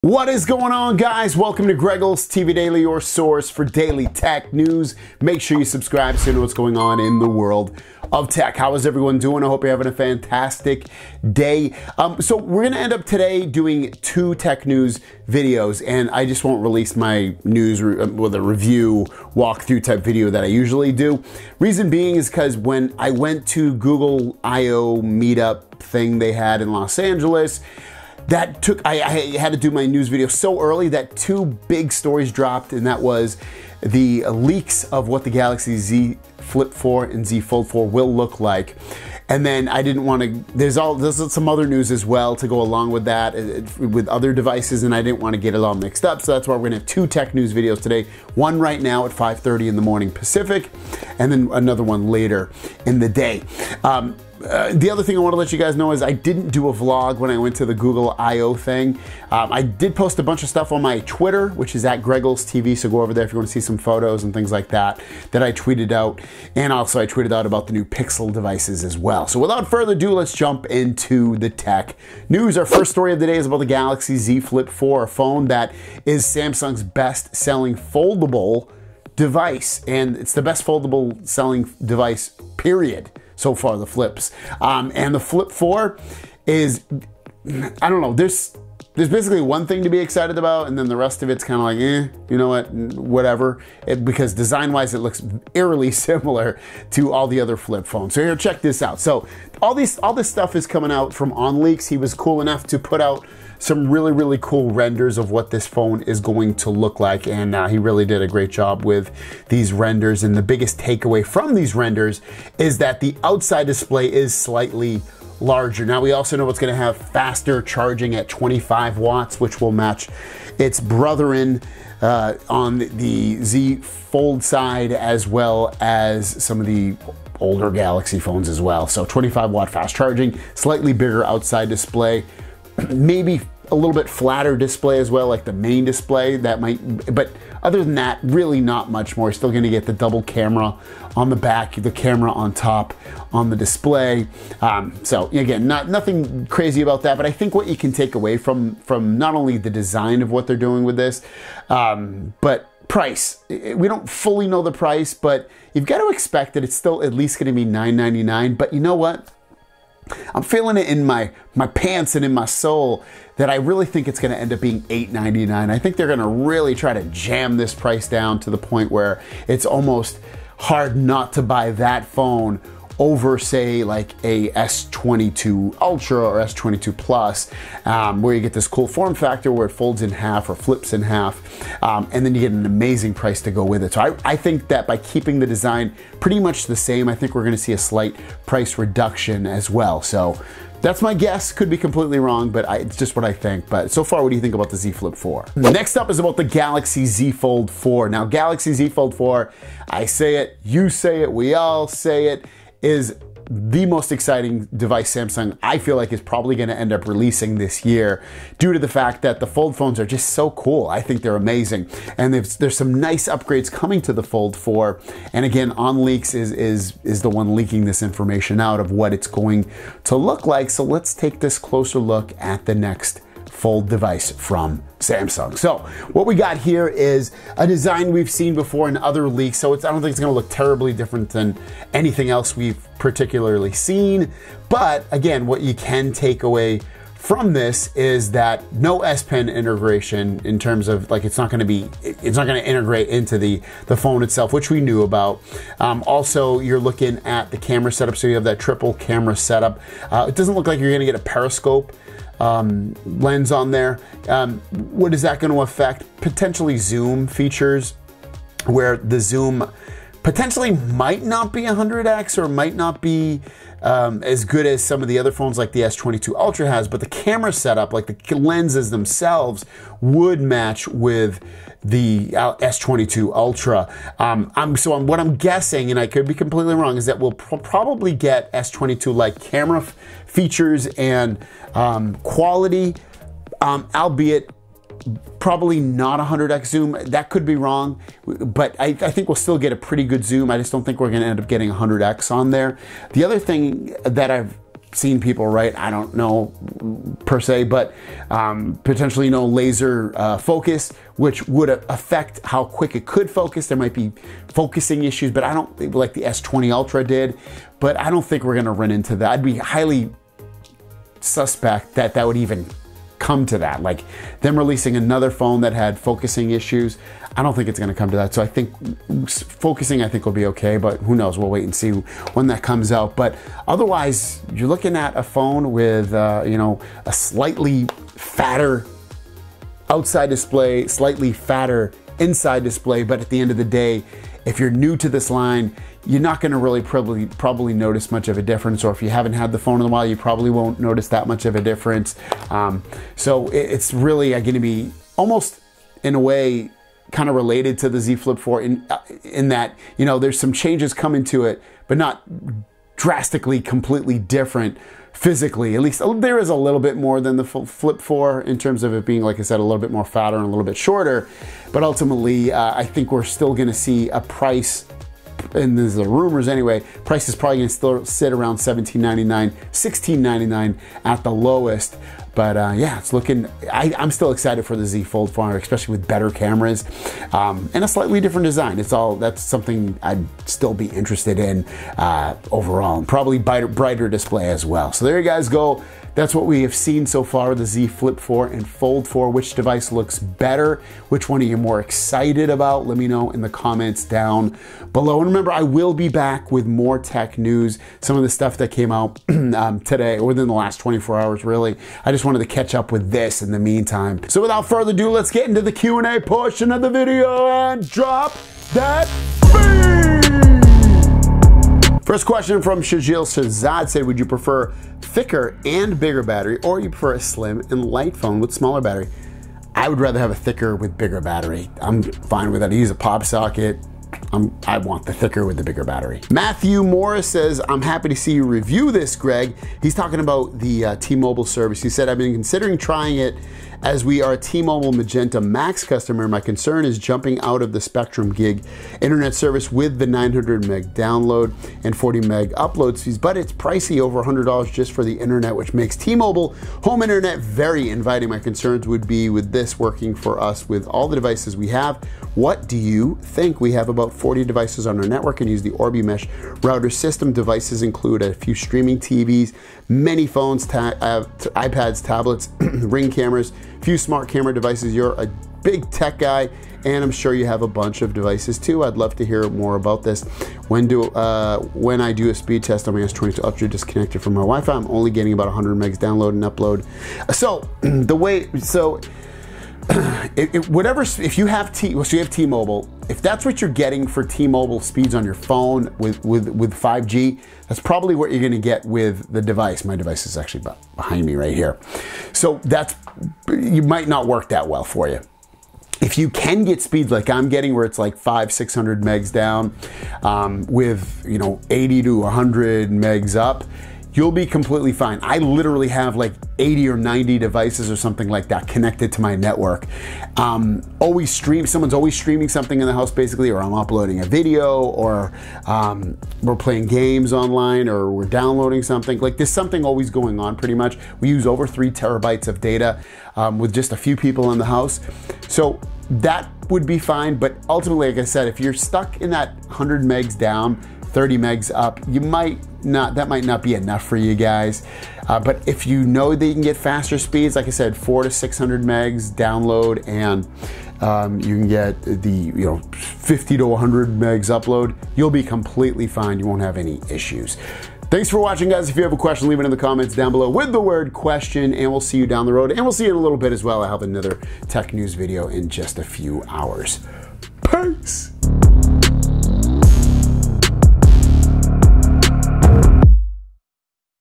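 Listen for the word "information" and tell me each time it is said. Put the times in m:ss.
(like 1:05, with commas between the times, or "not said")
3:38.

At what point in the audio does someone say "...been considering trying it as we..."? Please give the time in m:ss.
7:12.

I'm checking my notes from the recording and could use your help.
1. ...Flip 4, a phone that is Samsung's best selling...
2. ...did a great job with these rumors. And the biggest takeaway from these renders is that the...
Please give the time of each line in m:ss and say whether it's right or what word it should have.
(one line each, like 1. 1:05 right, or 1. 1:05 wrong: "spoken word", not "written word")
1. 1:14 right
2. 1:48 wrong: "renders", not "rumors".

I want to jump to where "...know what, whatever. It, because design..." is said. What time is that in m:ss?
1:32.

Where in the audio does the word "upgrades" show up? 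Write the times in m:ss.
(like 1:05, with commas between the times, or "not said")
3:33.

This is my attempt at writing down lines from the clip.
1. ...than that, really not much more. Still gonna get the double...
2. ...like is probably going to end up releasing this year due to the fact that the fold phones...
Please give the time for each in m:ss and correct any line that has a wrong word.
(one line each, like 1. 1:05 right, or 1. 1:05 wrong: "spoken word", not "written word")
1. 2:17 right
2. 3:25 right.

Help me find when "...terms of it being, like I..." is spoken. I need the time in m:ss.
5:58.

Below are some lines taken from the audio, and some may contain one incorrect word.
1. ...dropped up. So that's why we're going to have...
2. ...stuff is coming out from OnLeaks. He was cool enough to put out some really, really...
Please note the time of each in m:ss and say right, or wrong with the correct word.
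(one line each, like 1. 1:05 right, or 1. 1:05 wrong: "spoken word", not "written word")
1. 0:45 wrong: "mixed", not "dropped"
2. 1:40 right.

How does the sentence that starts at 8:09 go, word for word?
My device is actually behind me right here.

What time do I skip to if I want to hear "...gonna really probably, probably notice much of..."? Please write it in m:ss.
5:36.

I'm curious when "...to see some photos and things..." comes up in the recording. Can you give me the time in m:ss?
1:03.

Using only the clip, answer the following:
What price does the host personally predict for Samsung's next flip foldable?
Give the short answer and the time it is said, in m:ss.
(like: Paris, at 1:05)
$899, at 2:44.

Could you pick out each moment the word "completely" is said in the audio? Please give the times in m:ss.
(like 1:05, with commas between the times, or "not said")
3:11, 4:36, 5:53, 8:24, 9:05.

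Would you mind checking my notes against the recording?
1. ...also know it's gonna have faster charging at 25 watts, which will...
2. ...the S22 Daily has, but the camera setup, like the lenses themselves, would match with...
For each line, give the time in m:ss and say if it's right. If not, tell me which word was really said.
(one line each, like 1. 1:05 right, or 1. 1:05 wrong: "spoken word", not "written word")
1. 1:56 right
2. 4:25 wrong: "Ultra", not "Daily".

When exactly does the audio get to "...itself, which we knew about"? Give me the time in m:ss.
4:04.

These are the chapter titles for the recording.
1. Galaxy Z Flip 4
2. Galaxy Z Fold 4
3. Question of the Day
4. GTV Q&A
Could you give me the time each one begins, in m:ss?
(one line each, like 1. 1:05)
1. 1:12
2. 3:15
3. 6:25
4. 6:38.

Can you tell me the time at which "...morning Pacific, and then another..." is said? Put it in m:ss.
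0:49.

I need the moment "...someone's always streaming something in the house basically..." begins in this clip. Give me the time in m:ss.
8:31.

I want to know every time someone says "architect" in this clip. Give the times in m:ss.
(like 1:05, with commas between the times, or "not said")
not said.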